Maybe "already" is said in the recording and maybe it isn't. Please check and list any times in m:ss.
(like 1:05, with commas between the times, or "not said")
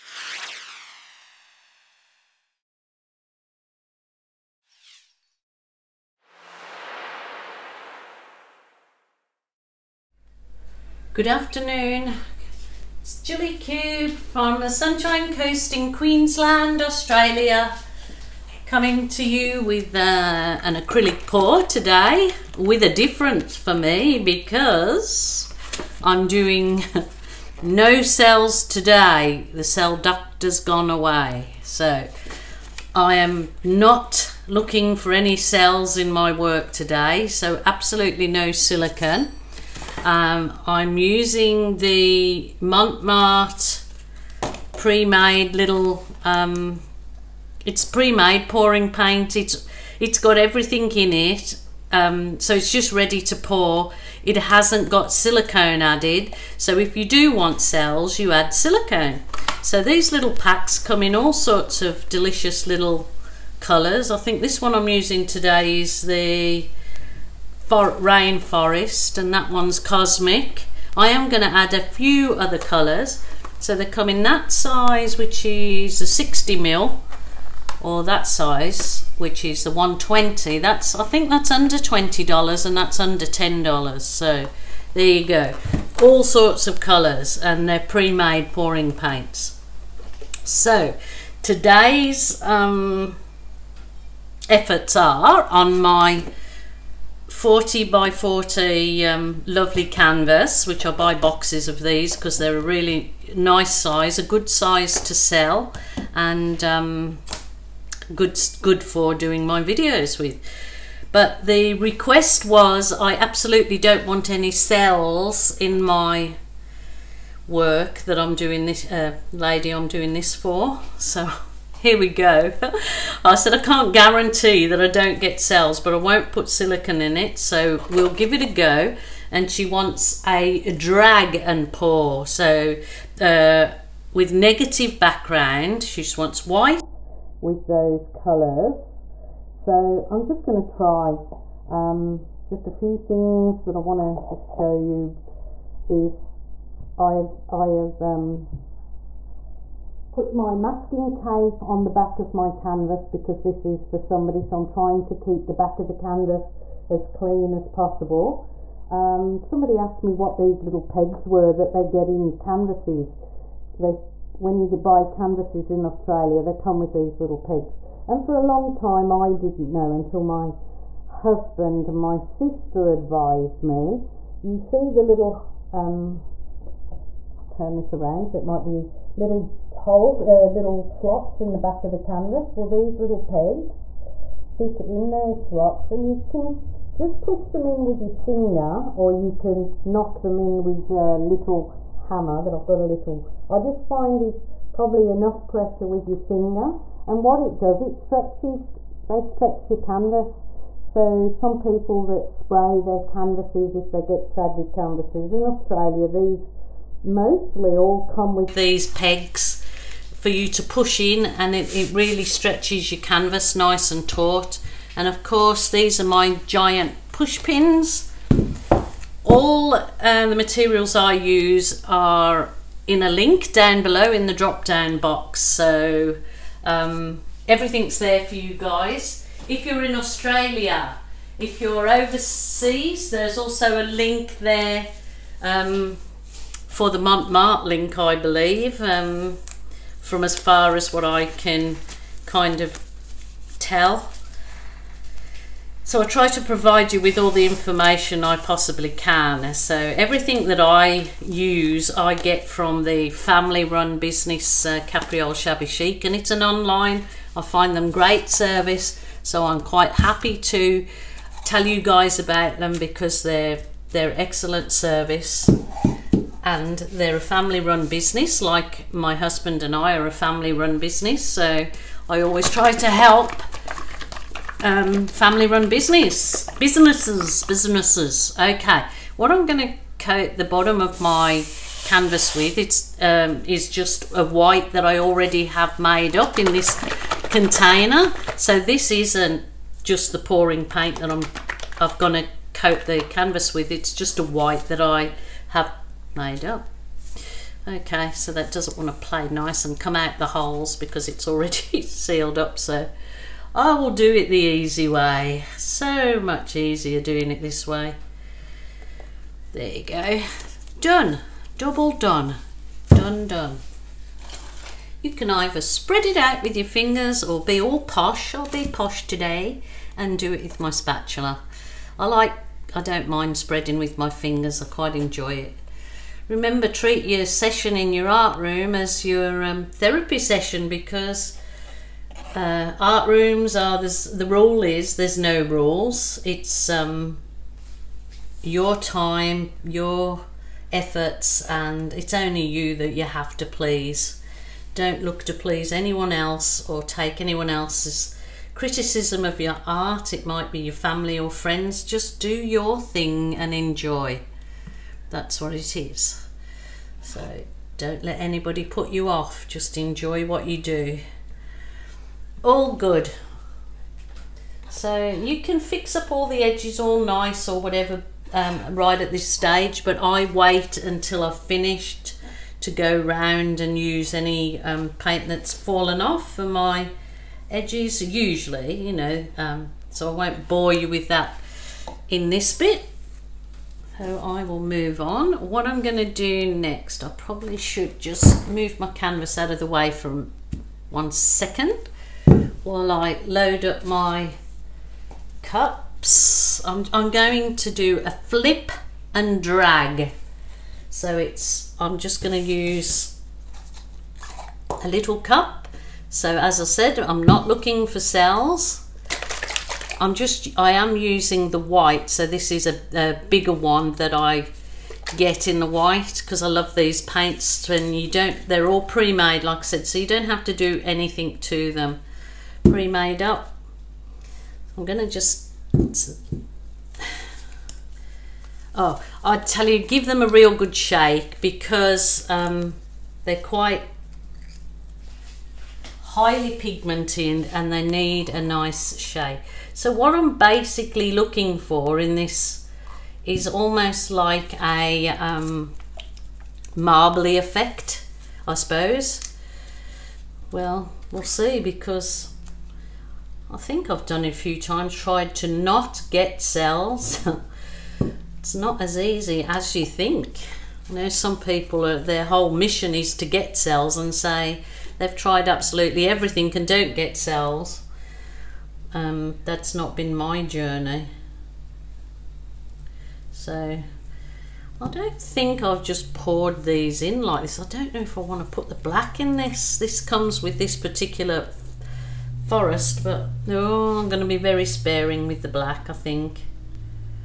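4:44, 5:01.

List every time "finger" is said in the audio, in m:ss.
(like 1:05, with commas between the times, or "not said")
3:08, 3:16, 5:16, 5:24.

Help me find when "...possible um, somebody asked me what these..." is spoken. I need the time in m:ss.
2:37.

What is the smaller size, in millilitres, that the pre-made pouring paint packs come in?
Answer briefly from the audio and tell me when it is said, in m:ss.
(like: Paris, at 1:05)
60 ml, at 1:16.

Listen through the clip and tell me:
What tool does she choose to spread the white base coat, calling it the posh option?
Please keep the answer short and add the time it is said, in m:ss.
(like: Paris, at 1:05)
Spatula, at 5:20.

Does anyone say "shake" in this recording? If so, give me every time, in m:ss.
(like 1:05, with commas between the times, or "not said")
7:10, 7:18.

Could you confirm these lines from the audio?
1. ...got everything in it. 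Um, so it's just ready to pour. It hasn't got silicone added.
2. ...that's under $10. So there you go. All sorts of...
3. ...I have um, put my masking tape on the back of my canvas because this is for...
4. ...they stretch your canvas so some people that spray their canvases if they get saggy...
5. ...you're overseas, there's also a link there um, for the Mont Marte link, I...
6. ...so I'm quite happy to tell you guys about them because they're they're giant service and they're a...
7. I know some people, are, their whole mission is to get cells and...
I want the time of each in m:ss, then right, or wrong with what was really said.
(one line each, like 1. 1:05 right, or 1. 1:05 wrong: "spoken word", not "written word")
1. 0:50 right
2. 1:22 right
3. 2:27 right
4. 3:19 right
5. 3:51 right
6. 4:19 wrong: "excellent", not "giant"
7. 7:40 right.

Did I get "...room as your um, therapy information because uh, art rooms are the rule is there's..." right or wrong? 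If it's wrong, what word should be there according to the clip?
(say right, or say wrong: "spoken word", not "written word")
wrong: "session", not "information".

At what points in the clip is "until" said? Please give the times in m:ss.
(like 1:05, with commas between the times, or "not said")
2:49, 6:10.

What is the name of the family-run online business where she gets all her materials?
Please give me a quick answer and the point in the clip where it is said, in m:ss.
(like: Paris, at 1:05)
Capriole Shabby Chic, at 4:14.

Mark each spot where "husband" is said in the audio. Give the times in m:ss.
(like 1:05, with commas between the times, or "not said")
2:51, 4:29.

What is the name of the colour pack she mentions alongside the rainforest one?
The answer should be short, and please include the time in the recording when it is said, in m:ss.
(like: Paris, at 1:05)
Cosmic, at 1:09.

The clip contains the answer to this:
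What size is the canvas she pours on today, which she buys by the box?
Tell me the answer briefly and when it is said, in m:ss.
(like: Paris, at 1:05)
40 by 40, at 1:37.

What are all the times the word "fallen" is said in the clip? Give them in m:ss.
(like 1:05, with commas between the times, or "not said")
6:15.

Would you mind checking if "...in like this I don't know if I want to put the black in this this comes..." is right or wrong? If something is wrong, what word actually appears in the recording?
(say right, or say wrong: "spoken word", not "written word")
right.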